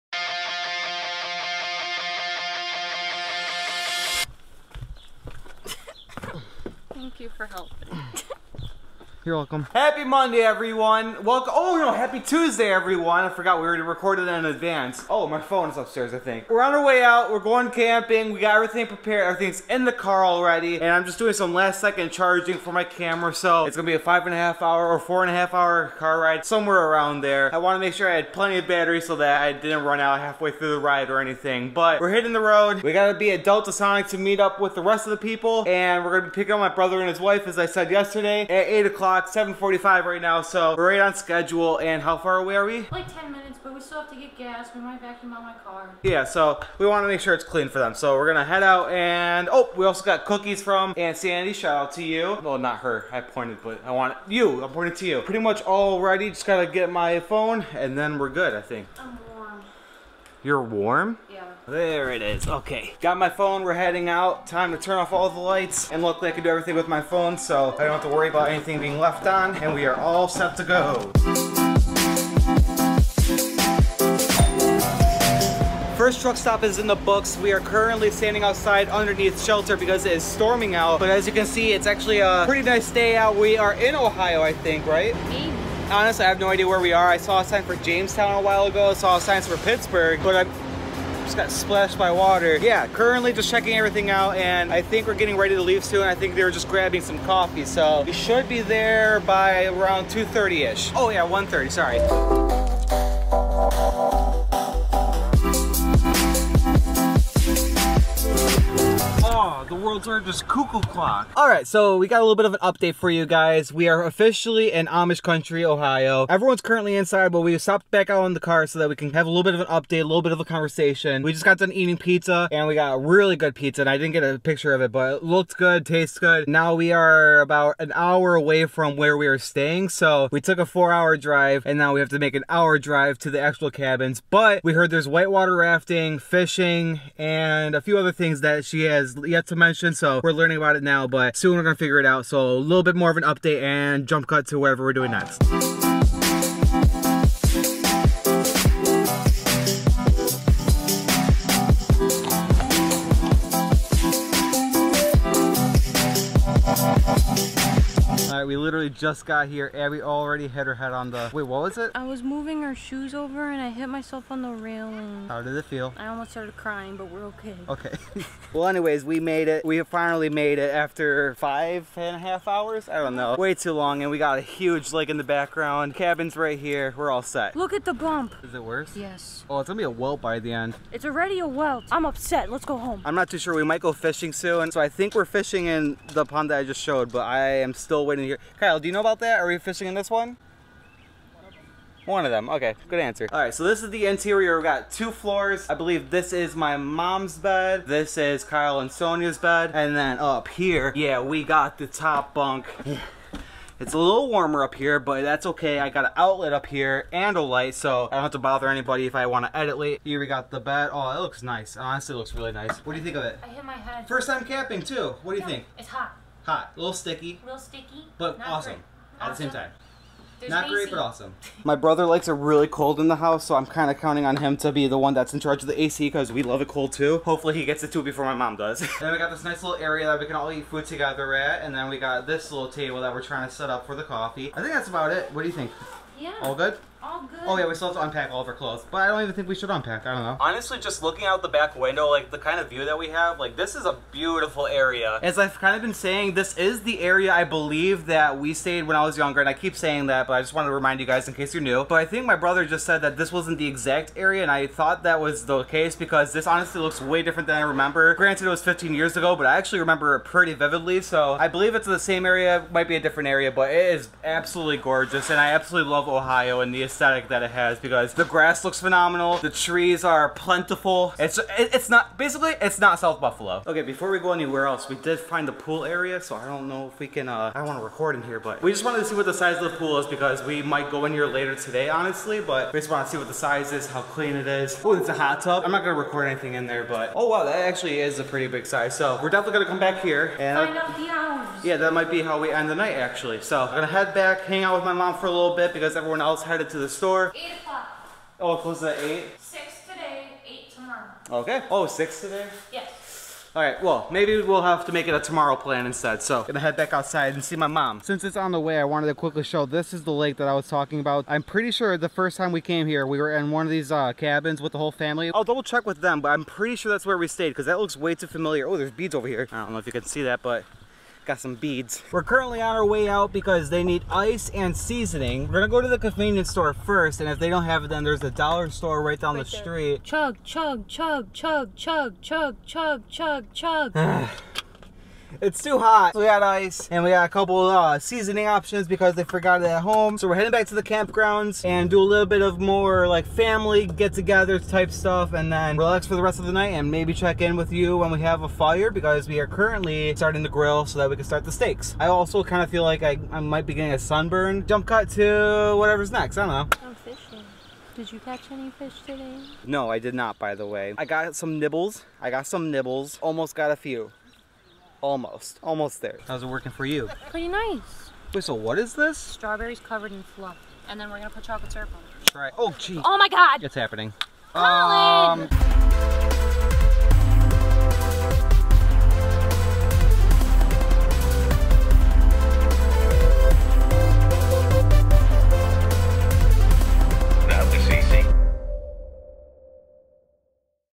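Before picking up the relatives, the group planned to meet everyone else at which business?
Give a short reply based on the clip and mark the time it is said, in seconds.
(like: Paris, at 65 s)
Delta Sonic, at 33 s.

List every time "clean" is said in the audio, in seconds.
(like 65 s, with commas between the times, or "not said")
47 s, 284 s.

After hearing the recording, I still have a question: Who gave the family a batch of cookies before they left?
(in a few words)
Aunt Sandy.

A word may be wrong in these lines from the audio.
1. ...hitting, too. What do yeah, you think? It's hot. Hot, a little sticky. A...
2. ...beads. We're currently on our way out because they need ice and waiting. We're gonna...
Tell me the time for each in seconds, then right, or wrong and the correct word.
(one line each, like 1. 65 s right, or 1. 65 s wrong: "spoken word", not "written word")
1. 214 s wrong: "camping", not "hitting"
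2. 321 s wrong: "seasoning", not "waiting".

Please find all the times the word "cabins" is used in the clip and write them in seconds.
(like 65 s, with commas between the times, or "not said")
133 s, 175 s, 314 s.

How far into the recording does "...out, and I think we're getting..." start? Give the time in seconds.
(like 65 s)
94 s.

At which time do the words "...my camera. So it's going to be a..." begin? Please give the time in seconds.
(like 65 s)
22 s.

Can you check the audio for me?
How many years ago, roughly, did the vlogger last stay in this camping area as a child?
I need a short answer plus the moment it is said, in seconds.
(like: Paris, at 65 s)
15, at 258 s.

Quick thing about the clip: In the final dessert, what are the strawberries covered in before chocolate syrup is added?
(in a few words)
Fluff.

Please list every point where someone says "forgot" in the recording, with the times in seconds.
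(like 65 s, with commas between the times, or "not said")
13 s, 339 s.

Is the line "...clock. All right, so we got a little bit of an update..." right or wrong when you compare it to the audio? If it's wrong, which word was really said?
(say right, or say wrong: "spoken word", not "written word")
right.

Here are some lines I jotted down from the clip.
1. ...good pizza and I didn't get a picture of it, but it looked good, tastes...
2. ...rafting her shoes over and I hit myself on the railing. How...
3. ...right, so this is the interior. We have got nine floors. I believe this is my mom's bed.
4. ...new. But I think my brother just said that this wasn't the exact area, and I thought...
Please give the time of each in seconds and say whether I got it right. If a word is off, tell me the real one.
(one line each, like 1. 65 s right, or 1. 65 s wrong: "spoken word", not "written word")
1. 123 s right
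2. 162 s wrong: "moving", not "rafting"
3. 193 s wrong: "two", not "nine"
4. 251 s right.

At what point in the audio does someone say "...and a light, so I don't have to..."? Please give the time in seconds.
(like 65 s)
207 s.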